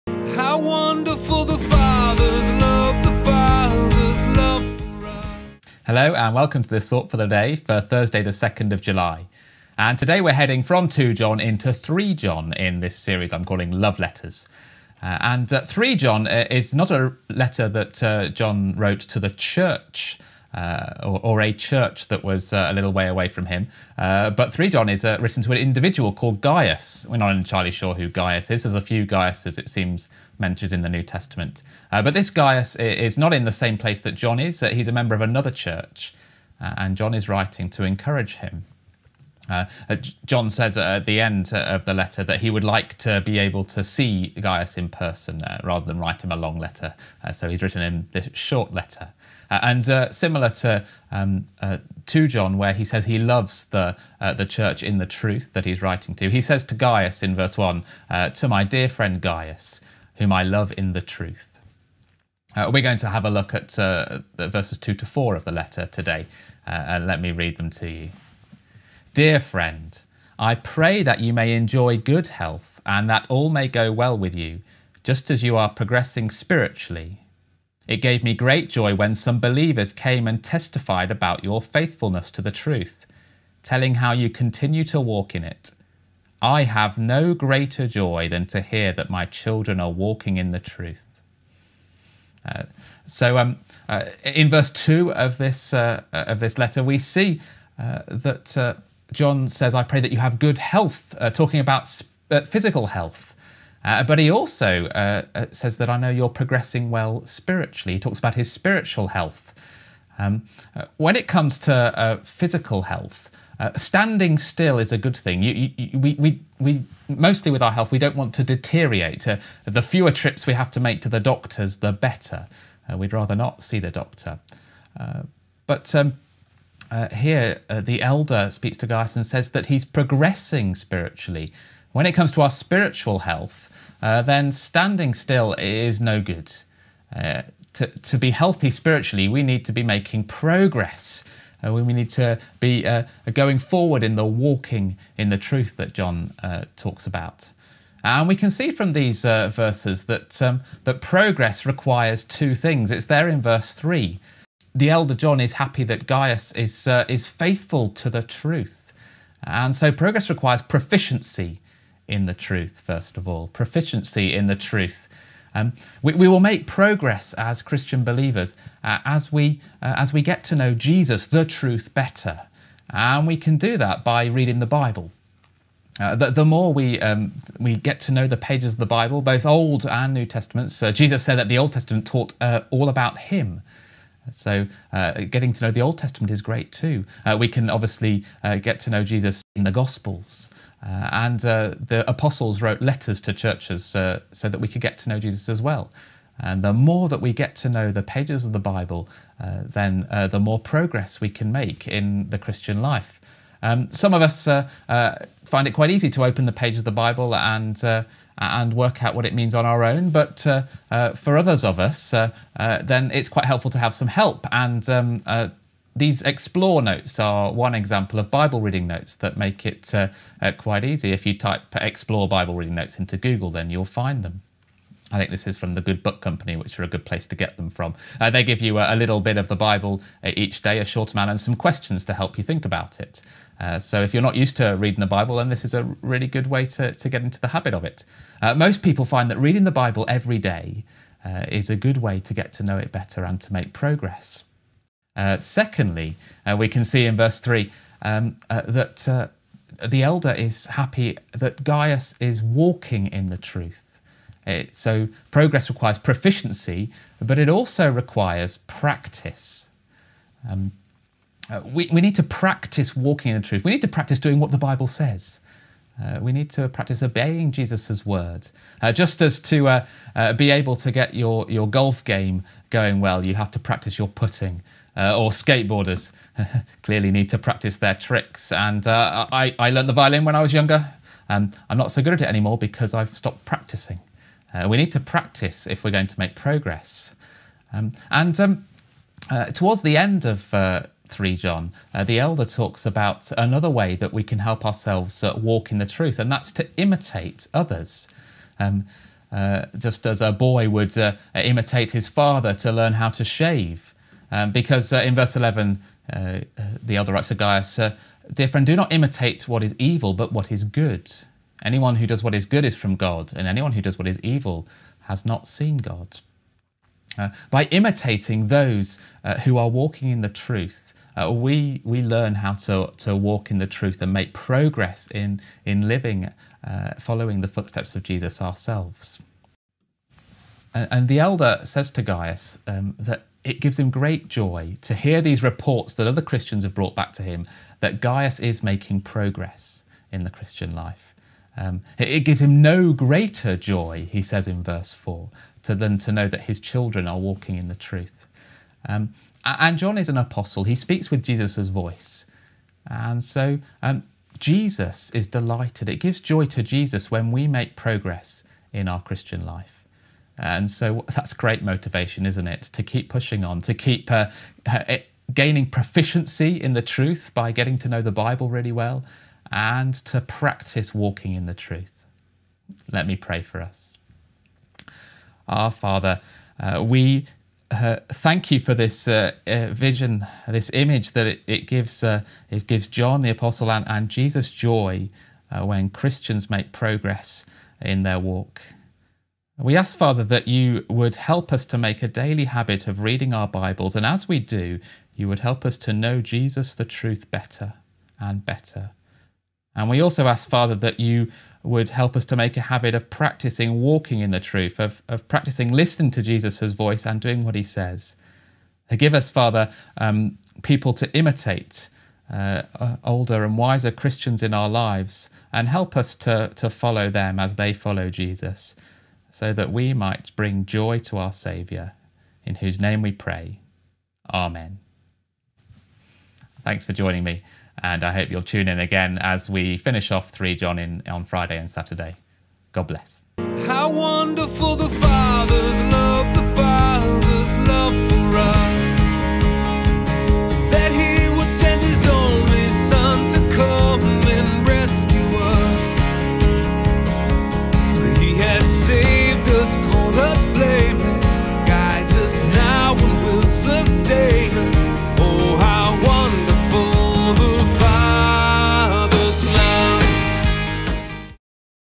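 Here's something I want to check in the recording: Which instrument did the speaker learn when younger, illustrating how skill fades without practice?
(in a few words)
Violin.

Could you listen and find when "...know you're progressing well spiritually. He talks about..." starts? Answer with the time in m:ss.
1:45.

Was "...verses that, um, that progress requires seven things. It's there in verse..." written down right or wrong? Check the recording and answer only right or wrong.
wrong.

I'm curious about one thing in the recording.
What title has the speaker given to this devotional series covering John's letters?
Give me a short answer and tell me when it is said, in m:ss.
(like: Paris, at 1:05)
Love Letters, at 0:13.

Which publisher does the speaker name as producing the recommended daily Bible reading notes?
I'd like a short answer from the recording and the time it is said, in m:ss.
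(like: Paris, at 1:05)
The Good Book Company, at 3:45.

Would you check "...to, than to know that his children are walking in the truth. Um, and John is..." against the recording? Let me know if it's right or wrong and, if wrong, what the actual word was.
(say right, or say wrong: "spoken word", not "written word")
right.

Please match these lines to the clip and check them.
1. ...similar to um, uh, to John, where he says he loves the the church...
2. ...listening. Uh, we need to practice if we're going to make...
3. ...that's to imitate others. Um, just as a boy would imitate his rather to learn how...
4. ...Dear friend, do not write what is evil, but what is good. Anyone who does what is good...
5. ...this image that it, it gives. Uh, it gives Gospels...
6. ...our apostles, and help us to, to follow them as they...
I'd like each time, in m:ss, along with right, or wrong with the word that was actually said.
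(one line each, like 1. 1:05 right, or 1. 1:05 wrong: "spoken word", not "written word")
1. 0:50 right
2. 4:43 wrong: "practicing", not "listening"
3. 4:56 wrong: "father", not "rather"
4. 5:08 wrong: "imitate", not "write"
5. 6:20 wrong: "John", not "Gospels"
6. 6:54 wrong: "lives", not "apostles".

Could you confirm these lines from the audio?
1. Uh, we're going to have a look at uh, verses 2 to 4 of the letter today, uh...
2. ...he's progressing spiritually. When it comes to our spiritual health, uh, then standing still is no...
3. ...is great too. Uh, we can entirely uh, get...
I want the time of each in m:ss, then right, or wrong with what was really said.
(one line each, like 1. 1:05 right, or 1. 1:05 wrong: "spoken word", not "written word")
1. 1:02 right
2. 2:09 right
3. 3:06 wrong: "obviously", not "entirely".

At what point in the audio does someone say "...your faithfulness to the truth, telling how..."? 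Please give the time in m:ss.
1:21.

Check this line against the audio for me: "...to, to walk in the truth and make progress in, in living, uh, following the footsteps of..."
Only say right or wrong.
right.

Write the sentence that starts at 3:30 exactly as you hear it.
But uh, uh, for others of us, uh, uh, then it's quite helpful to have some help.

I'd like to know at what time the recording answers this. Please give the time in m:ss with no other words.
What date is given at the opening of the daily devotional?
0:07.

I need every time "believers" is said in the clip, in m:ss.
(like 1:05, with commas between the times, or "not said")
1:19, 2:48.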